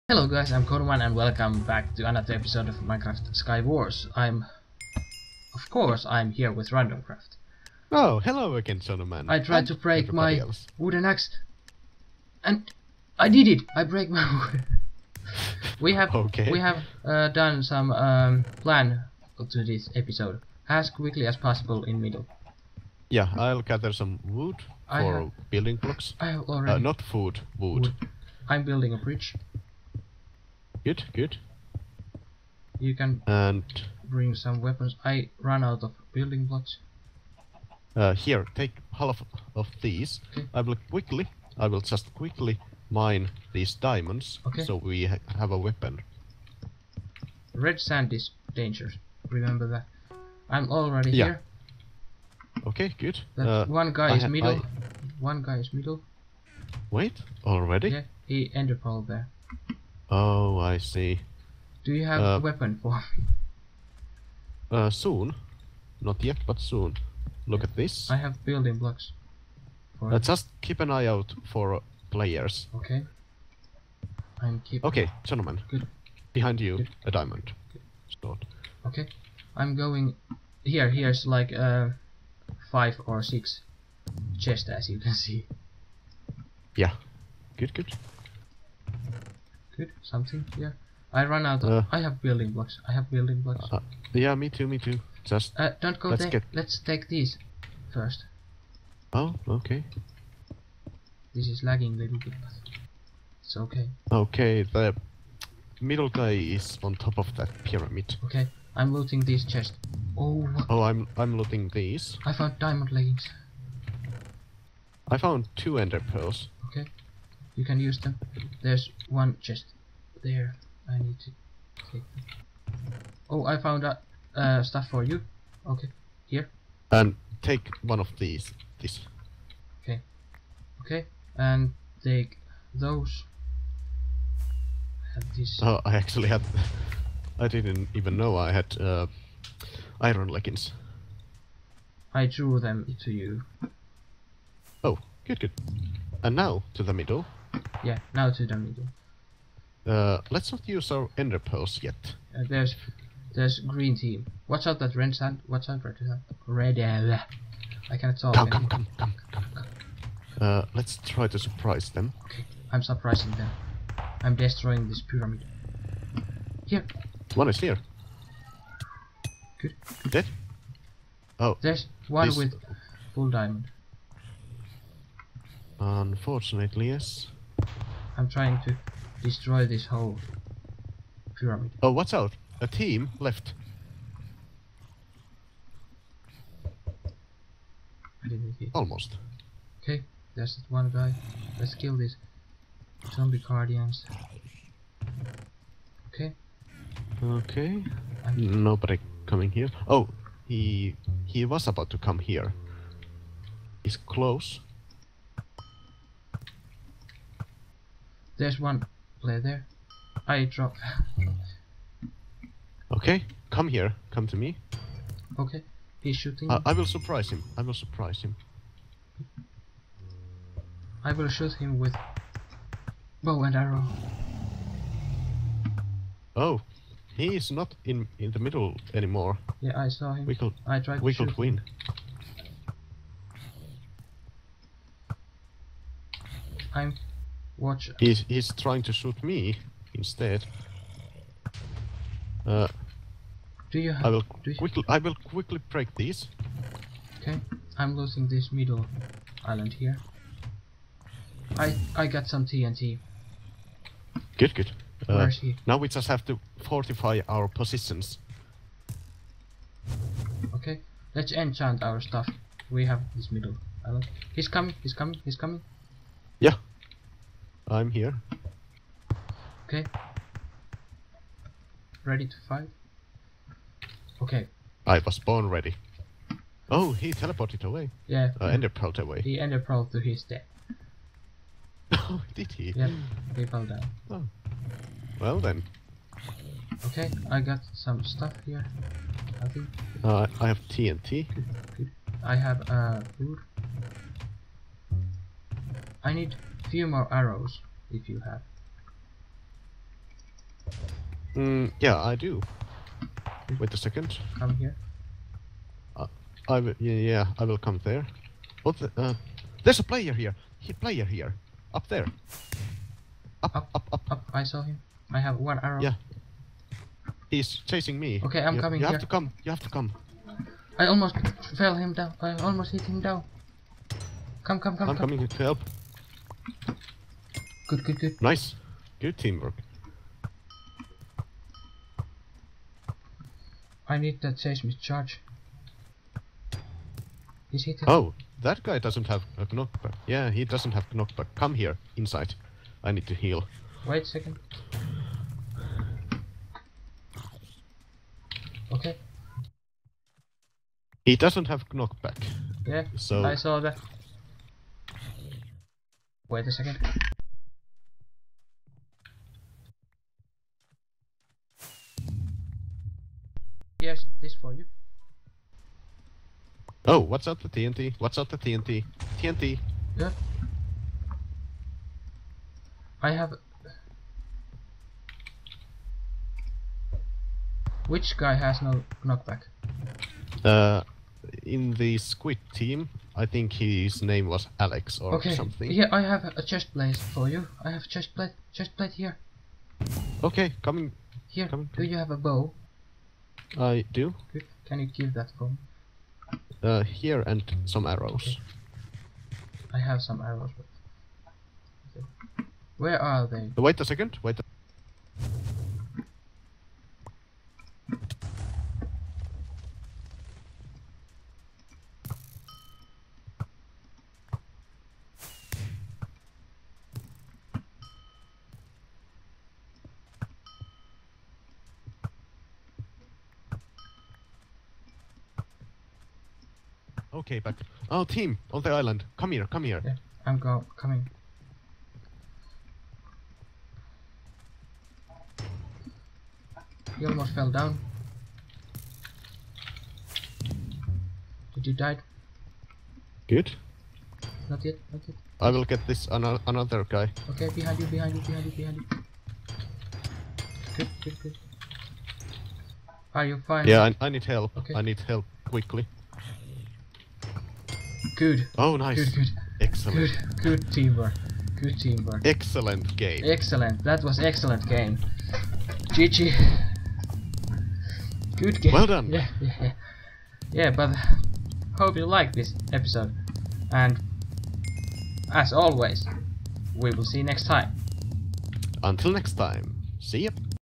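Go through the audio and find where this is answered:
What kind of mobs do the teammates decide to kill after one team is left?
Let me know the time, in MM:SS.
03:13.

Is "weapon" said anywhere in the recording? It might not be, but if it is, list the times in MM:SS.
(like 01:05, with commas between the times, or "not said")
00:34, 00:45, 01:02.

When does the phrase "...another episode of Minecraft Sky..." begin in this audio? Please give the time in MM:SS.
00:02.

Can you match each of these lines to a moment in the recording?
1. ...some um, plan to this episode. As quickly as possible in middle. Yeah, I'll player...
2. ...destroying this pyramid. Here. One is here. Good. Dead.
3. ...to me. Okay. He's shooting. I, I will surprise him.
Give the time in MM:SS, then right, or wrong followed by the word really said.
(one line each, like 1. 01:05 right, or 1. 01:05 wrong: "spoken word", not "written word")
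1. 00:17 wrong: "gather", not "player"
2. 02:44 right
3. 03:34 right.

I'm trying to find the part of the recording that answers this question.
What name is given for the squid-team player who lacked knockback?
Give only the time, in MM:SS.
06:24.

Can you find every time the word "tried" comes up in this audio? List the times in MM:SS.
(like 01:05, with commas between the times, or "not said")
00:09, 03:50.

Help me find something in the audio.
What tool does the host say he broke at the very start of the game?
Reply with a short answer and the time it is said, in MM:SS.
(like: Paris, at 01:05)
wooden axe, at 00:10.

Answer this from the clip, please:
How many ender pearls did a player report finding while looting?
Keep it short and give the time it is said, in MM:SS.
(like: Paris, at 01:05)
2, at 01:55.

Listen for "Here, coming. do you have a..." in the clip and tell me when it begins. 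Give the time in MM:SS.
06:31.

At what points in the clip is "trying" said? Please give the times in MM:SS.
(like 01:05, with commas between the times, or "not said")
02:58, 03:58.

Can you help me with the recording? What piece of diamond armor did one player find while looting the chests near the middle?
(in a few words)
diamond leggings.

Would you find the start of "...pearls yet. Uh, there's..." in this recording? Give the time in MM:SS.
02:31.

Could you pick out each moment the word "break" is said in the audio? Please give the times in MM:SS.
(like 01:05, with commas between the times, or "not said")
00:09, 00:13, 04:05.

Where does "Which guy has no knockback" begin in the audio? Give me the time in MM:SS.
06:17.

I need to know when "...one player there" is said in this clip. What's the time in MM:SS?
03:28.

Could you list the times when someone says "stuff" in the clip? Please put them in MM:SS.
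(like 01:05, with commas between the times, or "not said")
02:04, 04:22, 04:48.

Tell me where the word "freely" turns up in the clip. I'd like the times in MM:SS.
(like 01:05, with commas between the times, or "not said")
not said.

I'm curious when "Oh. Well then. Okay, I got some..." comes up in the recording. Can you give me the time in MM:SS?
04:44.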